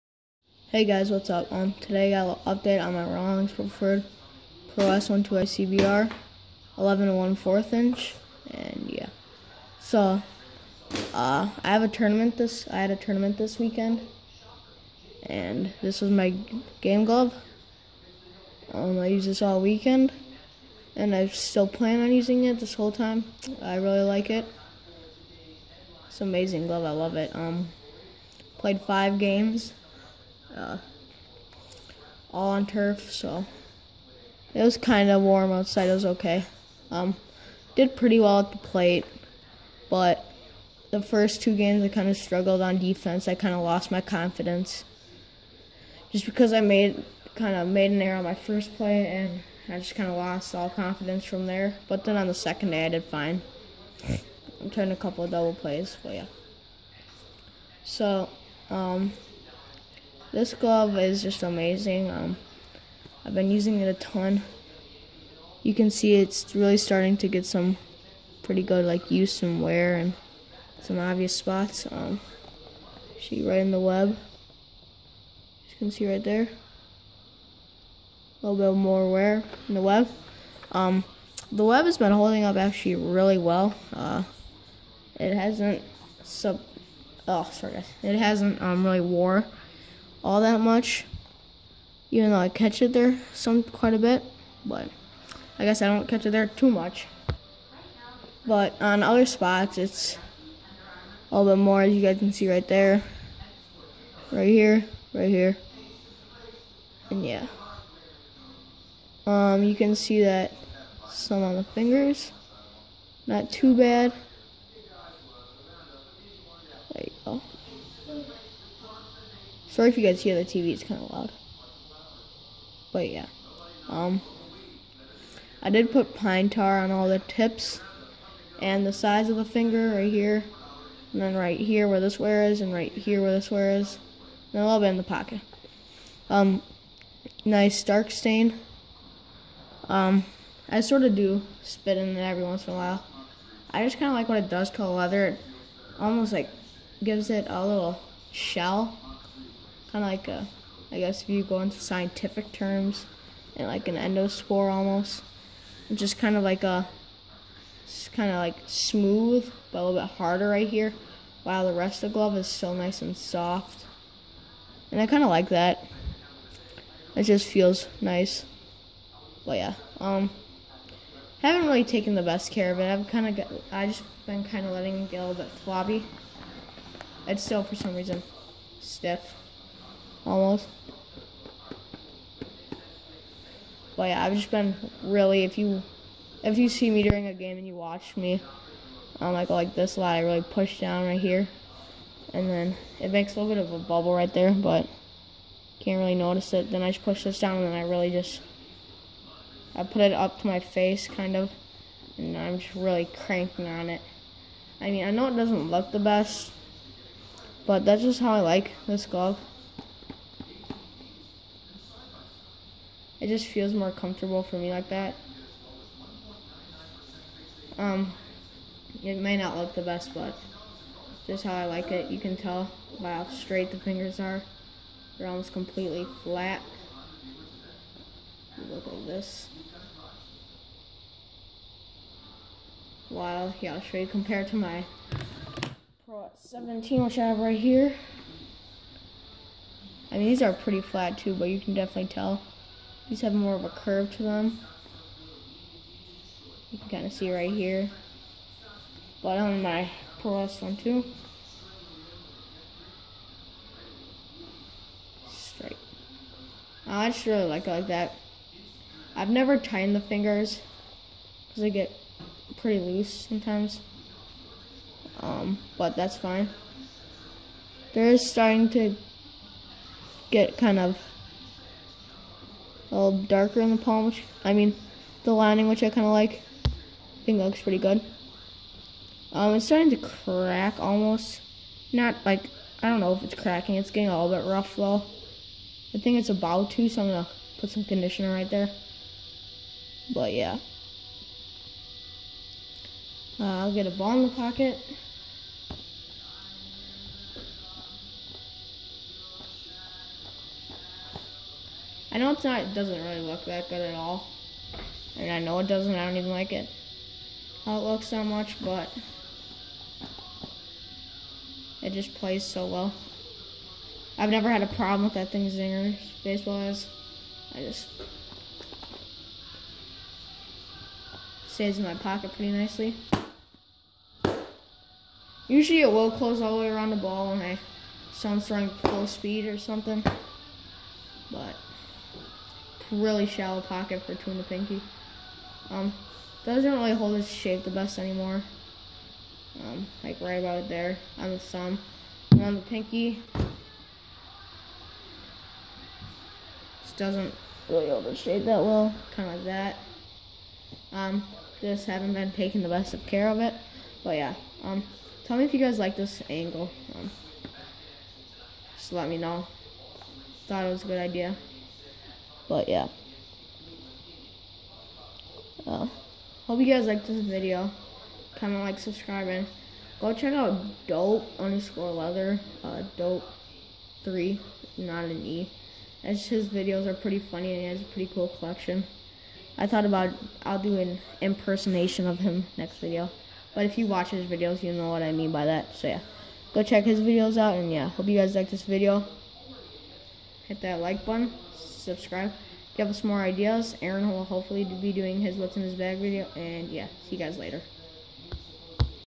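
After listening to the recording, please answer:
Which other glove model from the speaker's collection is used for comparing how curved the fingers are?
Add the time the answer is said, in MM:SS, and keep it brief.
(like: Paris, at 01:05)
Pro 17, at 03:56.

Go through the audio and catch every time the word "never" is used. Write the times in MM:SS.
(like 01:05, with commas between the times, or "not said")
04:19, 05:14.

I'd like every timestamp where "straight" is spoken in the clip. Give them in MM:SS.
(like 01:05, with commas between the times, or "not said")
03:43, 04:15.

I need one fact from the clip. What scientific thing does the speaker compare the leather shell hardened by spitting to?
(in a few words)
an endospore.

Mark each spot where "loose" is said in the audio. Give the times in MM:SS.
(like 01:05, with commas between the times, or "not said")
04:22.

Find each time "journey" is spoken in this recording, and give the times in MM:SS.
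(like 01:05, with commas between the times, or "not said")
not said.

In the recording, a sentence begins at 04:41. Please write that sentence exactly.
Not, like, I don't know if it's cracking.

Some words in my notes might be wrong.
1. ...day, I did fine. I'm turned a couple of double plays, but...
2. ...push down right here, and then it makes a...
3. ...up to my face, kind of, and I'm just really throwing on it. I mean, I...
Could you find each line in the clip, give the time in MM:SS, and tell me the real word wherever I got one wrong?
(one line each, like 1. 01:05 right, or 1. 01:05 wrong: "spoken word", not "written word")
1. 00:52 right
2. 03:10 right
3. 03:20 wrong: "cranking", not "throwing".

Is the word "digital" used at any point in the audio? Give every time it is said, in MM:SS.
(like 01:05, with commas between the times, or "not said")
not said.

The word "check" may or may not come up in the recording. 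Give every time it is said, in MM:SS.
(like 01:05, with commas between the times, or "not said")
06:10, 06:26.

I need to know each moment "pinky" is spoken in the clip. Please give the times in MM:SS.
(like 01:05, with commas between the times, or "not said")
05:34, 05:42.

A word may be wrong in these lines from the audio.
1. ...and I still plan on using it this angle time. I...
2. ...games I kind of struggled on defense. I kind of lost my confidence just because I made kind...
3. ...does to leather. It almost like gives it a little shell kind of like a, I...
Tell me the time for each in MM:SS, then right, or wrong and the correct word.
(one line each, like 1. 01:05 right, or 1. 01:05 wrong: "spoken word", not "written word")
1. 00:20 wrong: "whole", not "angle"
2. 00:41 right
3. 02:24 right.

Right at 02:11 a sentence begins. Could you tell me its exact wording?
And then right here where this wear is and right here where this wear is.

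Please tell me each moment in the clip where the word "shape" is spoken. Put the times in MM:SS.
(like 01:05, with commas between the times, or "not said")
05:37, 05:48.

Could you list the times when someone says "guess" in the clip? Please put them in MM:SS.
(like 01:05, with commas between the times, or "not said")
01:35, 02:30.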